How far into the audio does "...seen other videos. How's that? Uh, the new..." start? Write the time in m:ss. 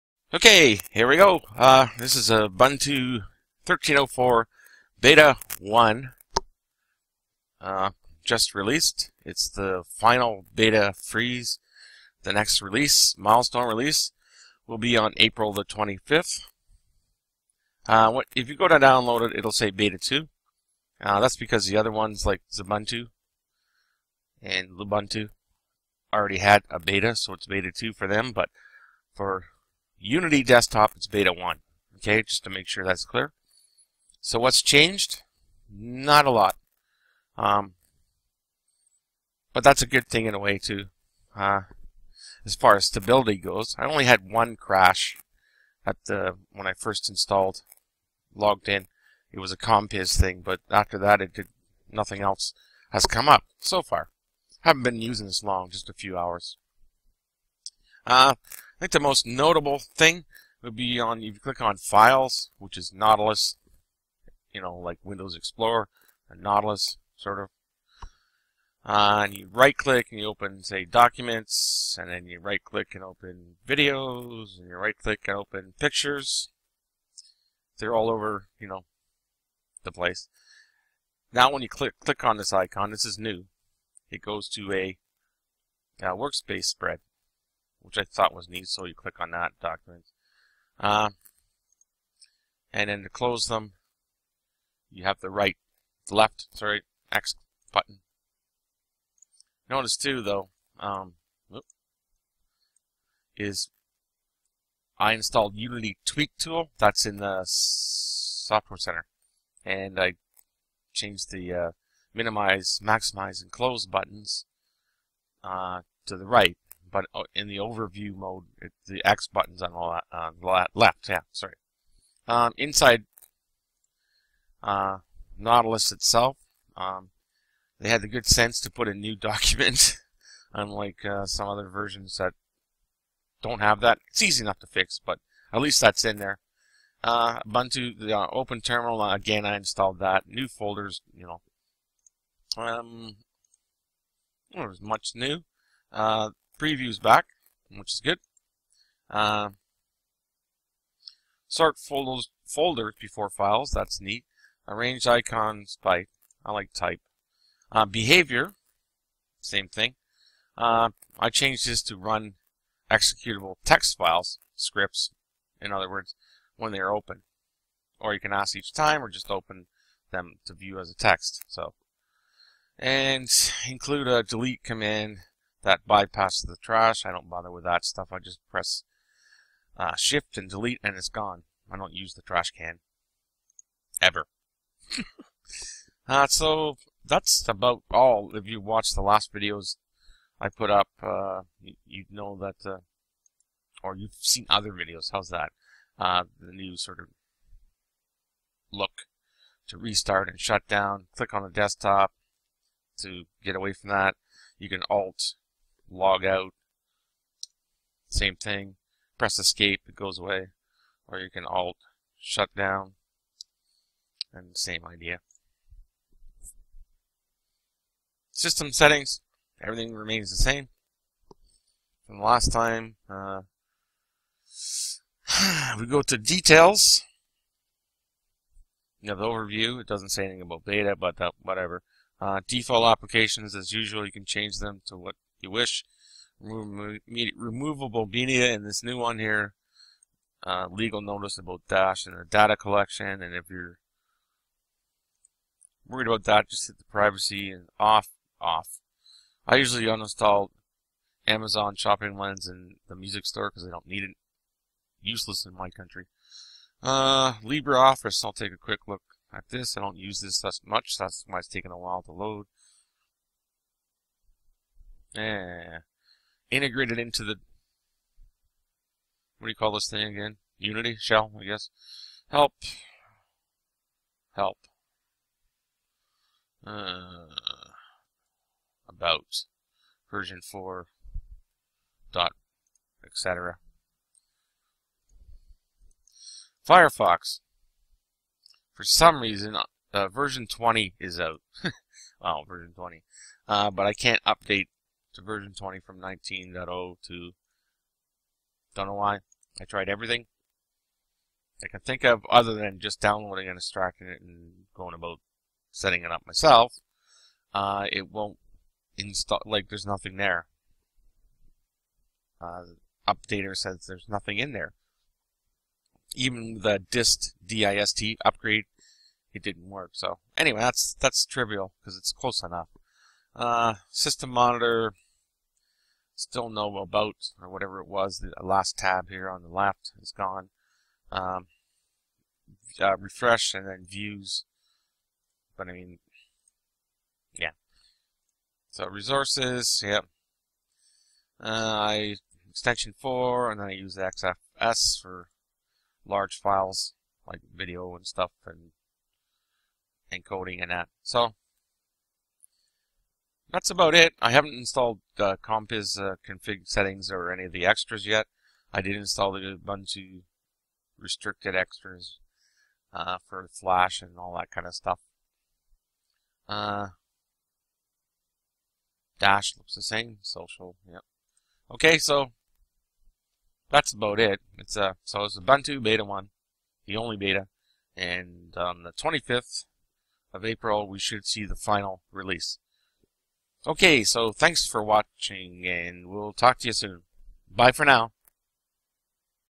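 3:14.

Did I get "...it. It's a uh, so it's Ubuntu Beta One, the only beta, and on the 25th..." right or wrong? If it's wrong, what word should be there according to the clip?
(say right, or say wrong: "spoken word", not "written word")
right.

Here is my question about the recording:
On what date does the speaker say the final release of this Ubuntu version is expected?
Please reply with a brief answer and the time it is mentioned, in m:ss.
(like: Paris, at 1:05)
April 25th, at 0:15.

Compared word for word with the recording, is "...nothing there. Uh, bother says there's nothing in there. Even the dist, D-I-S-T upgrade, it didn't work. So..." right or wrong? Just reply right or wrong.
wrong.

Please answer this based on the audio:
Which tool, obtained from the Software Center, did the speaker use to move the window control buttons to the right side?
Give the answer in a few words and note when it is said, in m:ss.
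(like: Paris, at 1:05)
Unity Tweak Tool, at 1:45.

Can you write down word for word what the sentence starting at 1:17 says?
They're all over, you know, the place.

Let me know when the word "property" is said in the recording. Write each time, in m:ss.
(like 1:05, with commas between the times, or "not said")
not said.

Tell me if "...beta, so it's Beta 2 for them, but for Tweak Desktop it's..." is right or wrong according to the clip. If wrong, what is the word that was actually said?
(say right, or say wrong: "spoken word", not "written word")
wrong: "Unity", not "Tweak".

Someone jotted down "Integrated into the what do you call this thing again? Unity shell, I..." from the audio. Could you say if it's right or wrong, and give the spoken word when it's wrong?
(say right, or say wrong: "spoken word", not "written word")
right.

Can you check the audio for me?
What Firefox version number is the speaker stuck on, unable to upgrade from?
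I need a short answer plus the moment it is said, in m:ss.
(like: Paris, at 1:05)
19.0, at 4:55.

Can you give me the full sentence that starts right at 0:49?
It was a Compiz thing, but after that, it did nothing else has come up so far.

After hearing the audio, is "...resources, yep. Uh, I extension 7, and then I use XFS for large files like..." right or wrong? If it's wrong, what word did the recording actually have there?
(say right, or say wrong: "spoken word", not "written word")
wrong: "4", not "7".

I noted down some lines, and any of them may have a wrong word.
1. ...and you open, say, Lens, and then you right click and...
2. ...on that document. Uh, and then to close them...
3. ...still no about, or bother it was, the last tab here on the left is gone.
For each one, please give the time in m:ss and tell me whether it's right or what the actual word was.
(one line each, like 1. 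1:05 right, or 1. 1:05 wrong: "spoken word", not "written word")
1. 1:10 wrong: "Documents", not "Lens"
2. 1:29 right
3. 5:26 wrong: "whatever", not "bother".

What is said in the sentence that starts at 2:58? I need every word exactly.
I just press uh, shift and delete and it's gone.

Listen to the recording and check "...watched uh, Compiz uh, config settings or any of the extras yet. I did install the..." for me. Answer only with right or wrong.
wrong.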